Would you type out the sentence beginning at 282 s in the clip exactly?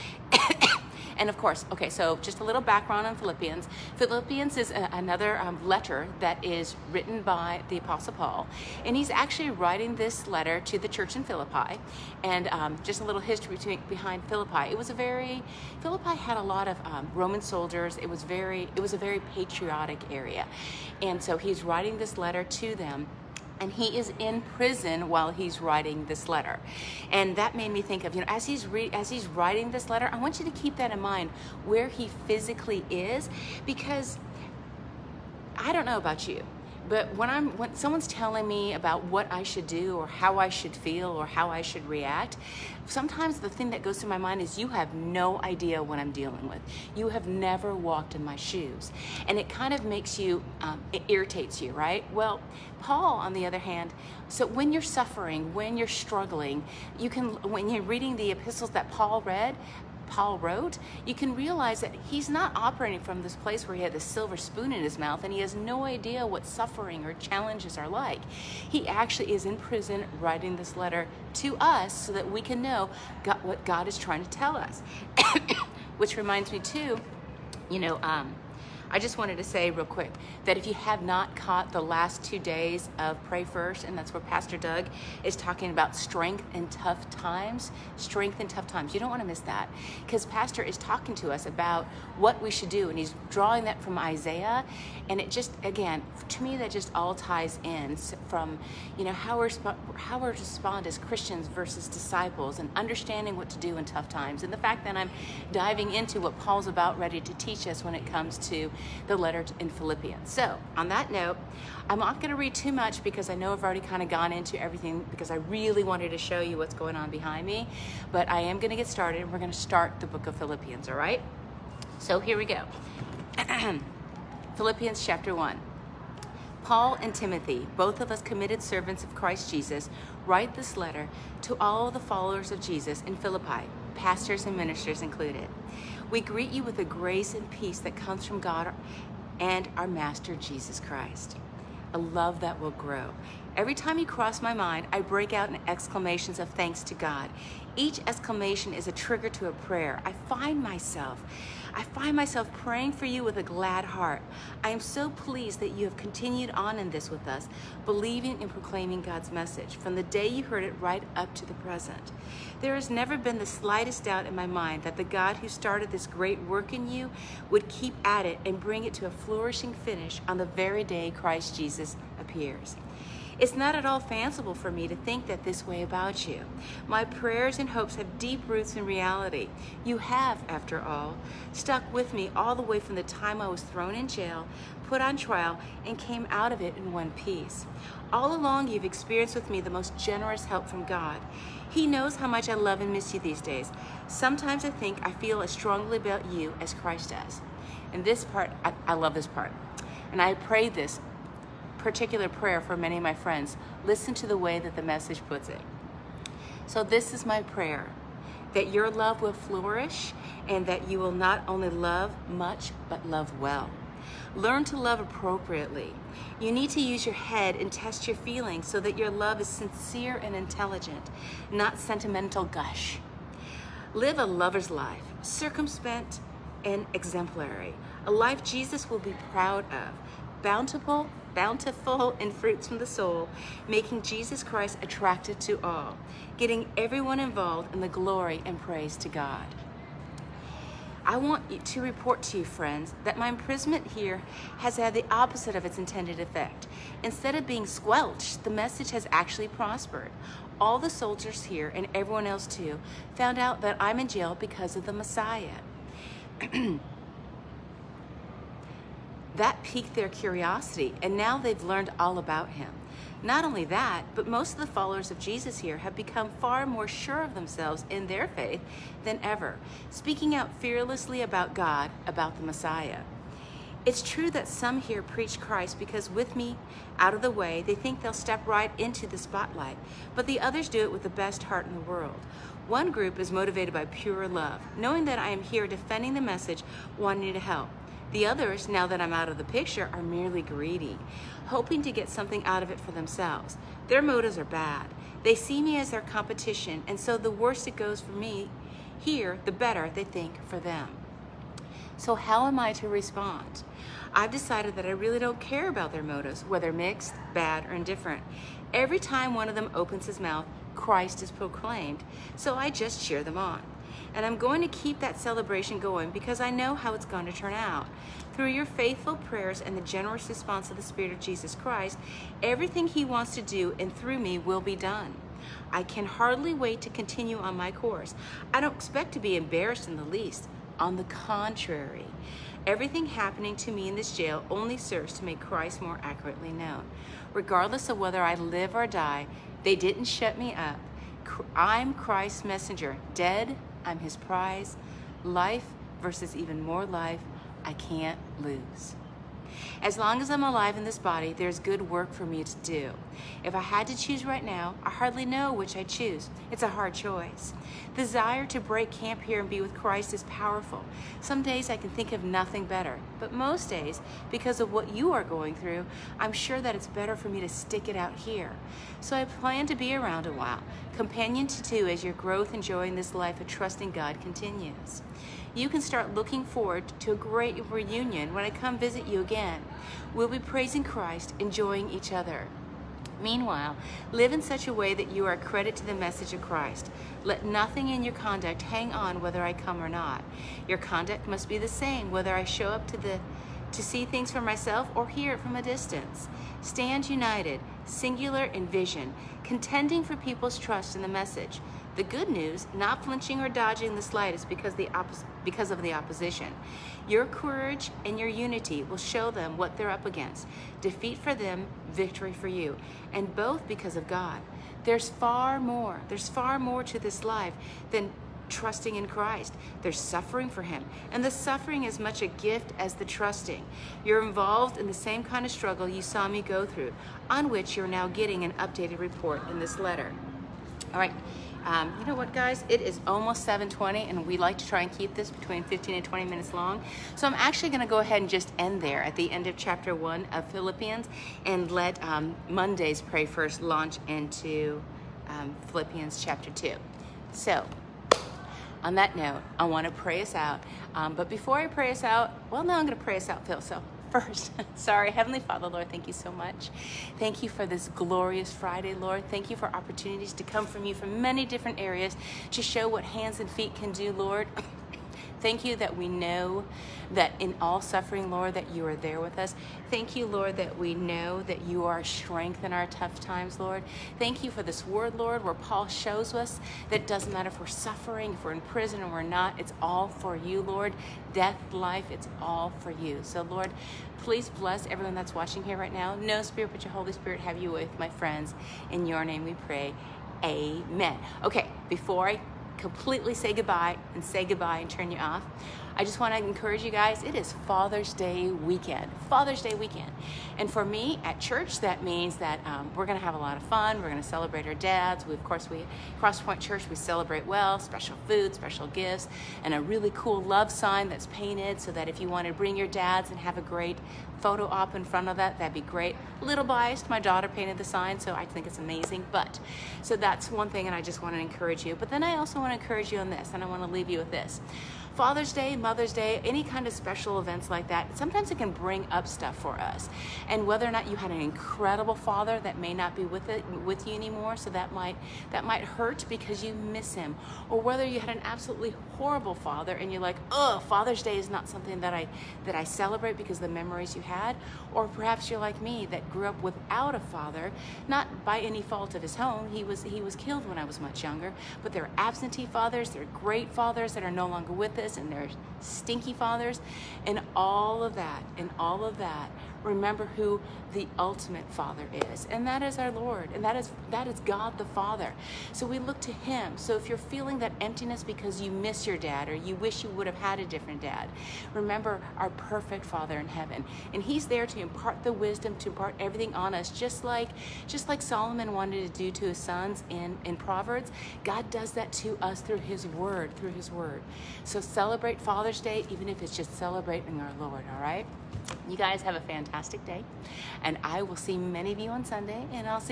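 One group is motivated by pure love, knowing that I am here defending the message, wanting to help.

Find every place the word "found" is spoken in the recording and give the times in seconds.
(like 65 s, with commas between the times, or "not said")
253 s.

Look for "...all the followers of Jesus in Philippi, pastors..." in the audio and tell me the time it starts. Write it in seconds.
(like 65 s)
131 s.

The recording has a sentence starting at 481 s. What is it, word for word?
Death, life, it's all for you.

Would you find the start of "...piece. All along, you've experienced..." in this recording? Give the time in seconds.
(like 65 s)
187 s.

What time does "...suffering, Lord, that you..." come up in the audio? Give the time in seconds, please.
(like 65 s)
467 s.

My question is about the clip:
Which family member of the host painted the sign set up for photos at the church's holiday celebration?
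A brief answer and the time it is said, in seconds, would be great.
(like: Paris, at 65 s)
daughter, at 517 s.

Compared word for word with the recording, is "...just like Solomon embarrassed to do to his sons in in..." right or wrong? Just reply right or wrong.
wrong.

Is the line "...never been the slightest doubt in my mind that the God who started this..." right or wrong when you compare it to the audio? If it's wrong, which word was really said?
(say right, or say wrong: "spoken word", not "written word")
right.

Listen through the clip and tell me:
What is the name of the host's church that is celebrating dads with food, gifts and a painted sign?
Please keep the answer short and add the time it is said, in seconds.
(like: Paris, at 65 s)
Crosspoint Church, at 506 s.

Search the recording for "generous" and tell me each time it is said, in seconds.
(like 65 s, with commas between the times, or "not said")
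189 s, 319 s.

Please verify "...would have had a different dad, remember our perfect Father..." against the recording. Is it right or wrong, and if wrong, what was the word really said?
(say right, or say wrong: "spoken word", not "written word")
right.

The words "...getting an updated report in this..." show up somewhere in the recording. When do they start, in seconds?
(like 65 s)
428 s.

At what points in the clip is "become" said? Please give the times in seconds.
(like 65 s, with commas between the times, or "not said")
265 s.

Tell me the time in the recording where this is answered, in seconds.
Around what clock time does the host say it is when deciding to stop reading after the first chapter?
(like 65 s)
433 s.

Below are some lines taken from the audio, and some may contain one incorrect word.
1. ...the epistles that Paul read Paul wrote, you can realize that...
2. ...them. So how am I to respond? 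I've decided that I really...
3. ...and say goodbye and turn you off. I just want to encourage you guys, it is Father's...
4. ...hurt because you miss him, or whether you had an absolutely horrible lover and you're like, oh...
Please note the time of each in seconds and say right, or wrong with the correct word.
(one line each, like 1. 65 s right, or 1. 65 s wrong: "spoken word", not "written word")
1. 58 s right
2. 300 s right
3. 494 s right
4. 535 s wrong: "father", not "lover".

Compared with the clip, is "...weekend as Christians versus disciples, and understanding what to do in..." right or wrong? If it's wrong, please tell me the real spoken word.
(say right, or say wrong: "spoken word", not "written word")
wrong: "respond", not "weekend".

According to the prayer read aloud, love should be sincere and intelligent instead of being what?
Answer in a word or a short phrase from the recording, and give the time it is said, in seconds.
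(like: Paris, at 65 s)
sentimental gush, at 221 s.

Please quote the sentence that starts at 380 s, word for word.
We'll be praising Christ, enjoying each other.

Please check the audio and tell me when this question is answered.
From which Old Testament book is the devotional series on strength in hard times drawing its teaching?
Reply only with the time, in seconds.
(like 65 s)
93 s.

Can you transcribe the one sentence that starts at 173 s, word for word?
It's not at all fanciful for me to think that this way about you.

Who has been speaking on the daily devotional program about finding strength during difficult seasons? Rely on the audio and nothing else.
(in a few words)
Pastor Doug.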